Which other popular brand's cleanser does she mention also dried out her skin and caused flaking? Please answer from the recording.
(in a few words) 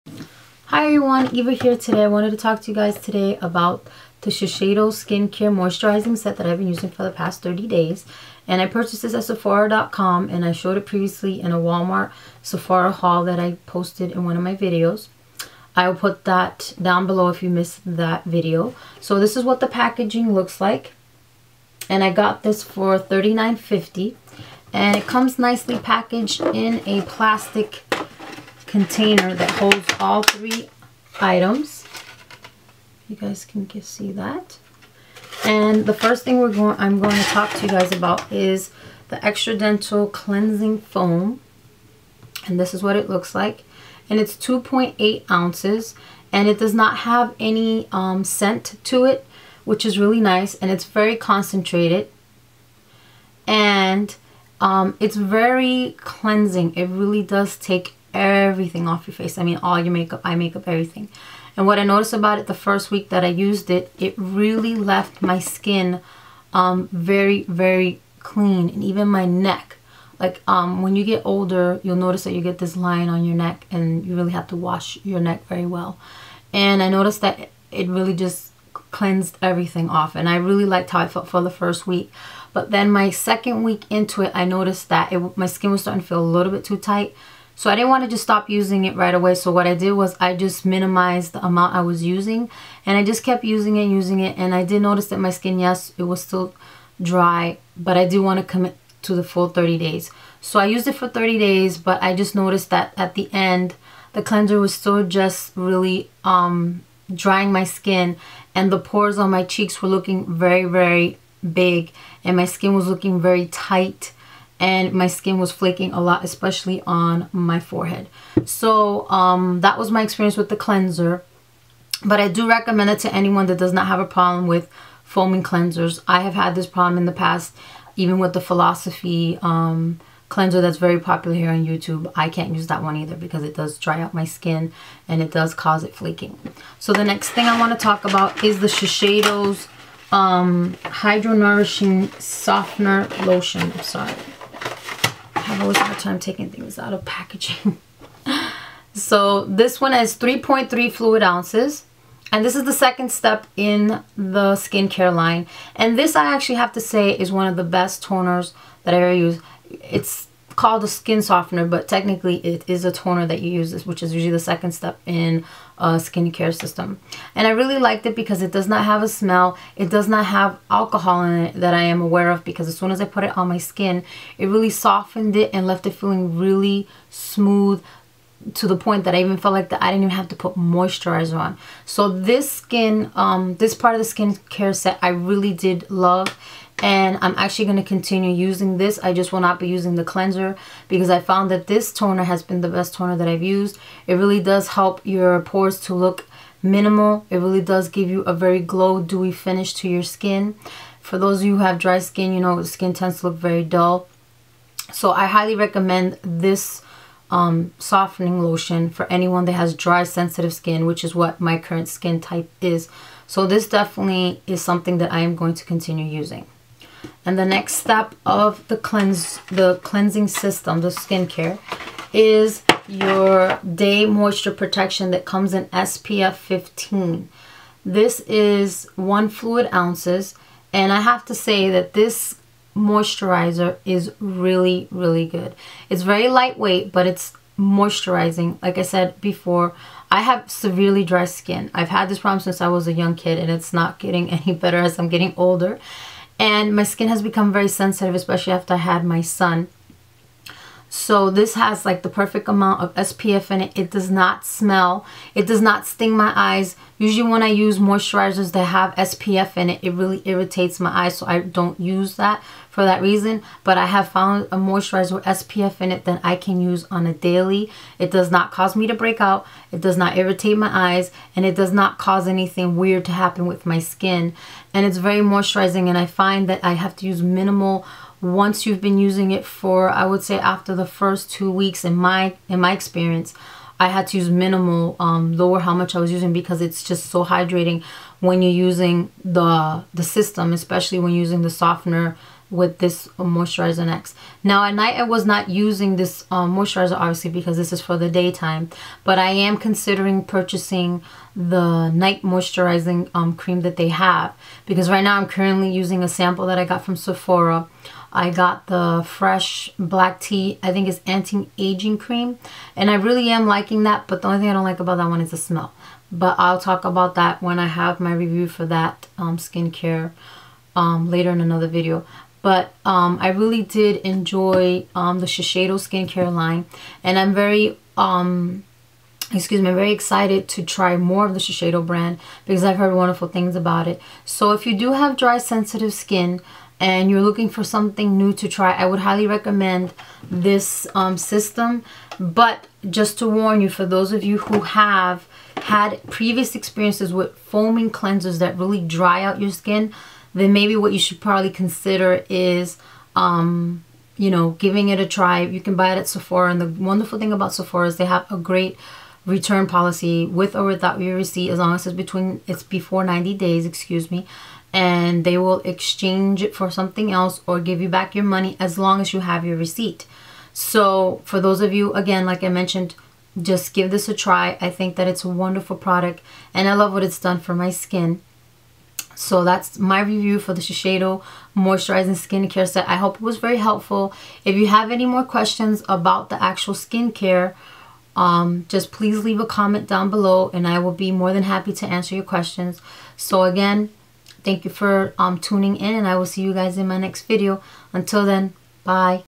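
Philosophy.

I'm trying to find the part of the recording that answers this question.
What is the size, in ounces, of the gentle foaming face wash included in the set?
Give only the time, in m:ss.
0:44.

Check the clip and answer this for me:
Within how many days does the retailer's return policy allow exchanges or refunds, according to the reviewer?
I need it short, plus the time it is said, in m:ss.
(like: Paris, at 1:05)
90, at 6:03.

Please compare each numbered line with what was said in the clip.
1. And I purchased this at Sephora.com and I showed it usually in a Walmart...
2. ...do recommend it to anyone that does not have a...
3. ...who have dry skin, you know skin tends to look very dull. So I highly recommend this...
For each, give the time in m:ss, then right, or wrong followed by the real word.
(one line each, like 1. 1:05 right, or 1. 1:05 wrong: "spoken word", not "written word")
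1. 0:08 wrong: "previously", not "usually"
2. 2:02 right
3. 3:21 right.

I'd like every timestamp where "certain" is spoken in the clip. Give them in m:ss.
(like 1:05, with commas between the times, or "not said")
not said.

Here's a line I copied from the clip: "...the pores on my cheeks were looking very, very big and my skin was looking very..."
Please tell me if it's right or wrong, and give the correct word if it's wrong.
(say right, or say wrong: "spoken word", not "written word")
right.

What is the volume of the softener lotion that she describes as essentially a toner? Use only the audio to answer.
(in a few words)
3.3 fluid ounces.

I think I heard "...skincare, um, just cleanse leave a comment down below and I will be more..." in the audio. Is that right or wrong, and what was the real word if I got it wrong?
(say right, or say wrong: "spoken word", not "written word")
wrong: "please", not "cleanse".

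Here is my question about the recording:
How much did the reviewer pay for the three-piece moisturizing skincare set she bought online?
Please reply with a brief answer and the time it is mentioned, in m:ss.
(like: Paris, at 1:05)
$39.50, at 0:22.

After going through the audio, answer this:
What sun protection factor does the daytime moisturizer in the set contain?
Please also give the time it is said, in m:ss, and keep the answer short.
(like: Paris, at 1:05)
SPF 15, at 3:45.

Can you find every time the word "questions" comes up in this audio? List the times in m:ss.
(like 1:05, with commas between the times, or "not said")
6:25, 6:32.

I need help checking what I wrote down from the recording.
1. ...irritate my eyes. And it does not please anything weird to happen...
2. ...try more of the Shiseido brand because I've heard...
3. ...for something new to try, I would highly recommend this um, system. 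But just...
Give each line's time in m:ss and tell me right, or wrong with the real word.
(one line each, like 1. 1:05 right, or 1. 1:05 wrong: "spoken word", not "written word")
1. 4:30 wrong: "cause", not "please"
2. 5:30 right
3. 5:37 right.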